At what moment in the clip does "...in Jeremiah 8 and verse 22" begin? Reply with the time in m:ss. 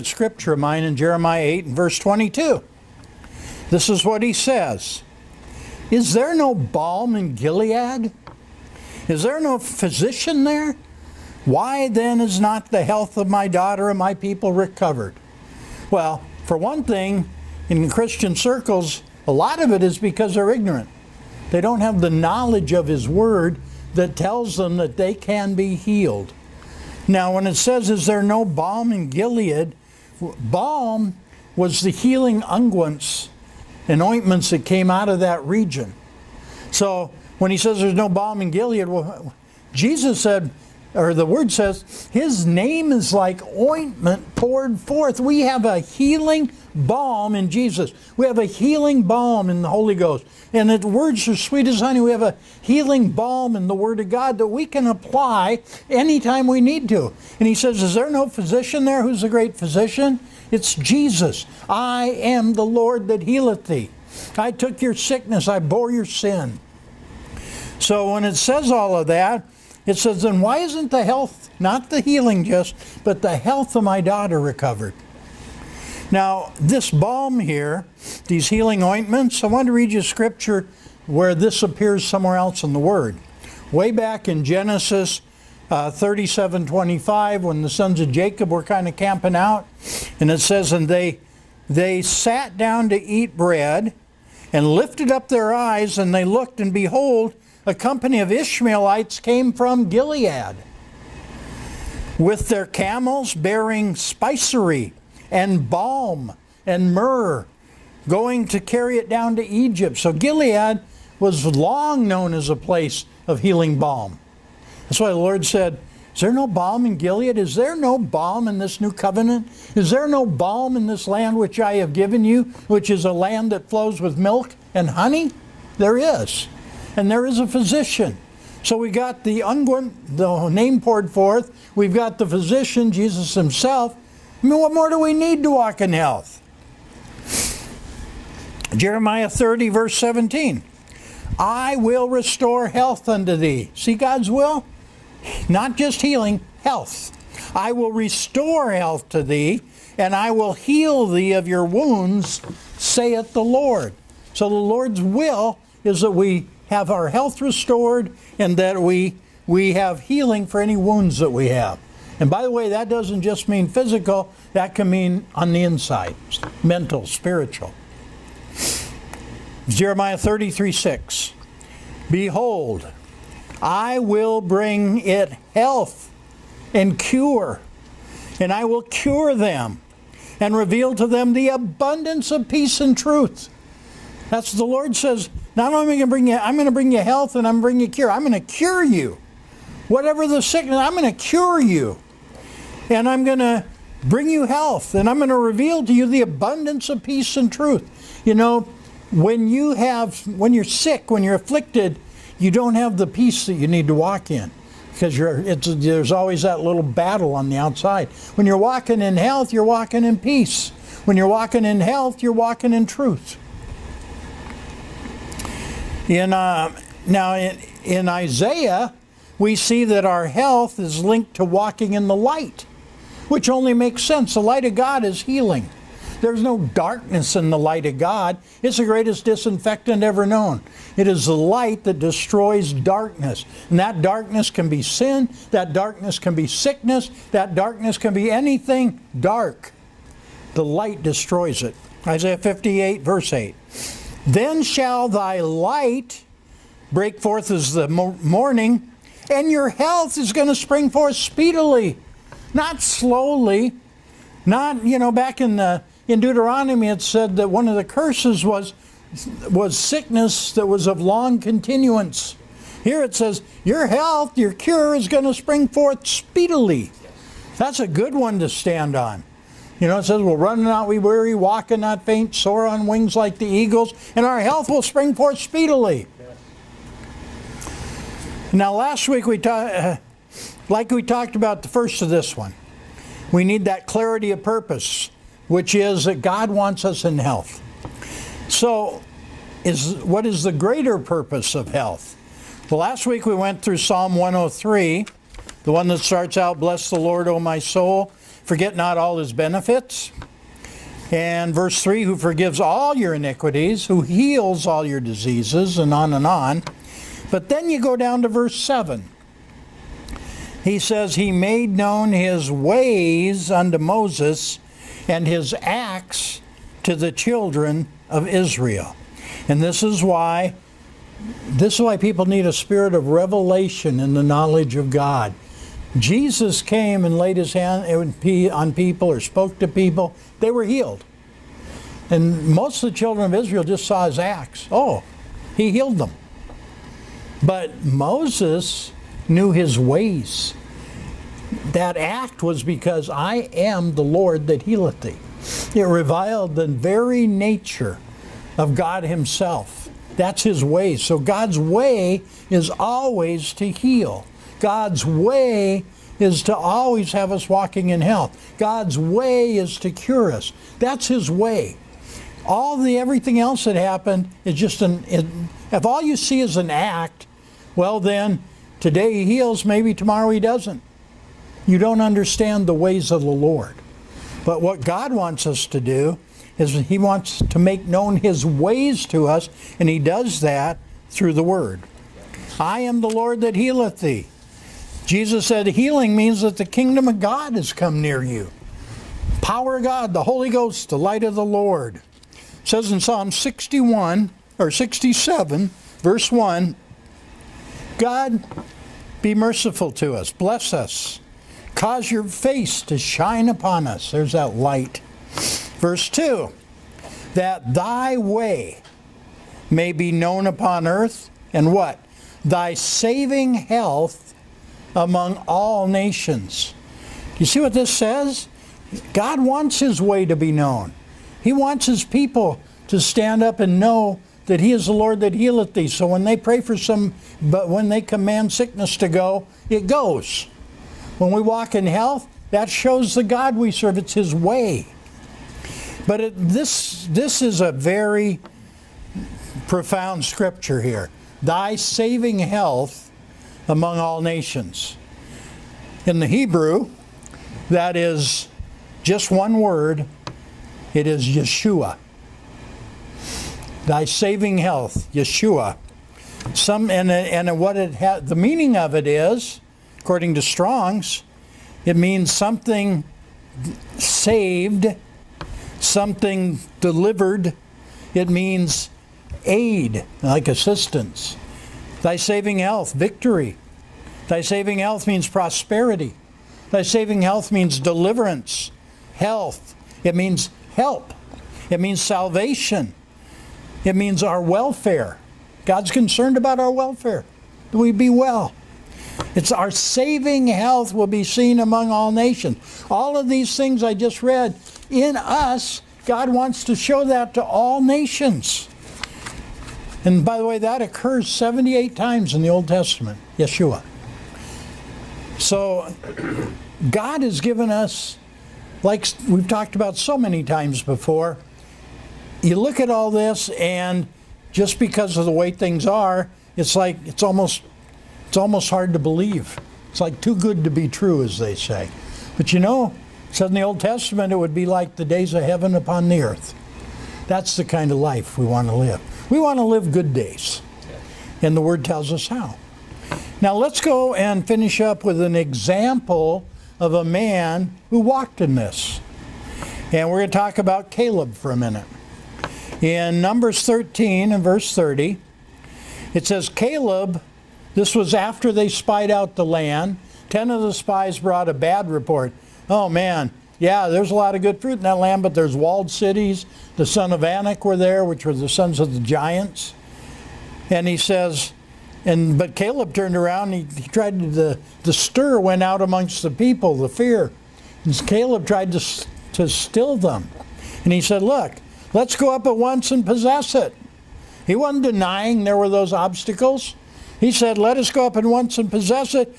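0:00.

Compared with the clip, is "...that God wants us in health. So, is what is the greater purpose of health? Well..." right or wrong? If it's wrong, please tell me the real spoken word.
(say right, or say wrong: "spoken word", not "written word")
right.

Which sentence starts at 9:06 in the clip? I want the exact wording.
It says, Caleb, this was after they spied out the land.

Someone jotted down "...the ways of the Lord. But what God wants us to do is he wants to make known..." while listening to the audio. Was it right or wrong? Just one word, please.
right.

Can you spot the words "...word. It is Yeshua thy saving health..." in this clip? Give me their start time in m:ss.
7:29.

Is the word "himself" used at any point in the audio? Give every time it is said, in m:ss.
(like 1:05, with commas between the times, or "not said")
2:13, 5:49.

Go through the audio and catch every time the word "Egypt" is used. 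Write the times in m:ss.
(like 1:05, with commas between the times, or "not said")
1:49.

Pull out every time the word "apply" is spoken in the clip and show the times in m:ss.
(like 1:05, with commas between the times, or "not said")
0:54.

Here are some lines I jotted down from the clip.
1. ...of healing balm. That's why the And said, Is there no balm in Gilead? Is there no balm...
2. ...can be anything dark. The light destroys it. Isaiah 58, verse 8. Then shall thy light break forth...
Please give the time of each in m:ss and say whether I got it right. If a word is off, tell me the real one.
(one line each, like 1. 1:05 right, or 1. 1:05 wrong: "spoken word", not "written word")
1. 1:53 wrong: "Lord", not "And"
2. 3:57 right.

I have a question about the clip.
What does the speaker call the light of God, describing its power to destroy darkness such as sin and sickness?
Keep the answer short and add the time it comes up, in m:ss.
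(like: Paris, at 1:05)
The greatest disinfectant, at 3:48.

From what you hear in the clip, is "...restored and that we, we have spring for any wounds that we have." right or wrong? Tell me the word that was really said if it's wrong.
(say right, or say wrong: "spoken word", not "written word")
wrong: "healing", not "spring".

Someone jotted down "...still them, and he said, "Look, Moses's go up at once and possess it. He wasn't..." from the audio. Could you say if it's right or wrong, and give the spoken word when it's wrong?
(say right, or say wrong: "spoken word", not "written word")
wrong: "Let", not "Moses".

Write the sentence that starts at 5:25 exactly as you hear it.
Jesus came and laid his hand on people or spoke to people, they were healed.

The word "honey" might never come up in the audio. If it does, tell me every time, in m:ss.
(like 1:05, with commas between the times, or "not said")
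0:51, 2:04.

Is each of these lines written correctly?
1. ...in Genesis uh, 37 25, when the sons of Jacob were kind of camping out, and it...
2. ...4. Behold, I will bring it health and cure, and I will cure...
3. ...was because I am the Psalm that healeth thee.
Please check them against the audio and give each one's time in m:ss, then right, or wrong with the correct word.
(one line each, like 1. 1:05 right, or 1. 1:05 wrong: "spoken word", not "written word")
1. 1:24 right
2. 2:50 wrong: "6", not "4"
3. 5:42 wrong: "Lord", not "Psalm".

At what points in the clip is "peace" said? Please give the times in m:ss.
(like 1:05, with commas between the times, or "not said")
3:02, 3:17, 3:23, 3:30.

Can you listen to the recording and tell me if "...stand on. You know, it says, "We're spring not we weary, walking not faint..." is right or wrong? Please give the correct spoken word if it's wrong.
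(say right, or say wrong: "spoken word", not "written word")
wrong: "running", not "spring".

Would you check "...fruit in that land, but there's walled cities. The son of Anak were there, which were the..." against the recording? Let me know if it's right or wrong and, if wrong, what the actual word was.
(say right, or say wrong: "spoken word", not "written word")
right.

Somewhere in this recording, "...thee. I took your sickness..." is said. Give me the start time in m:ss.
1:03.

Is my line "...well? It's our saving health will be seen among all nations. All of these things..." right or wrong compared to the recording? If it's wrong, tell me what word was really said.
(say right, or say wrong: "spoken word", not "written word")
right.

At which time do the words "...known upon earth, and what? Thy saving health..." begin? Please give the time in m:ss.
6:50.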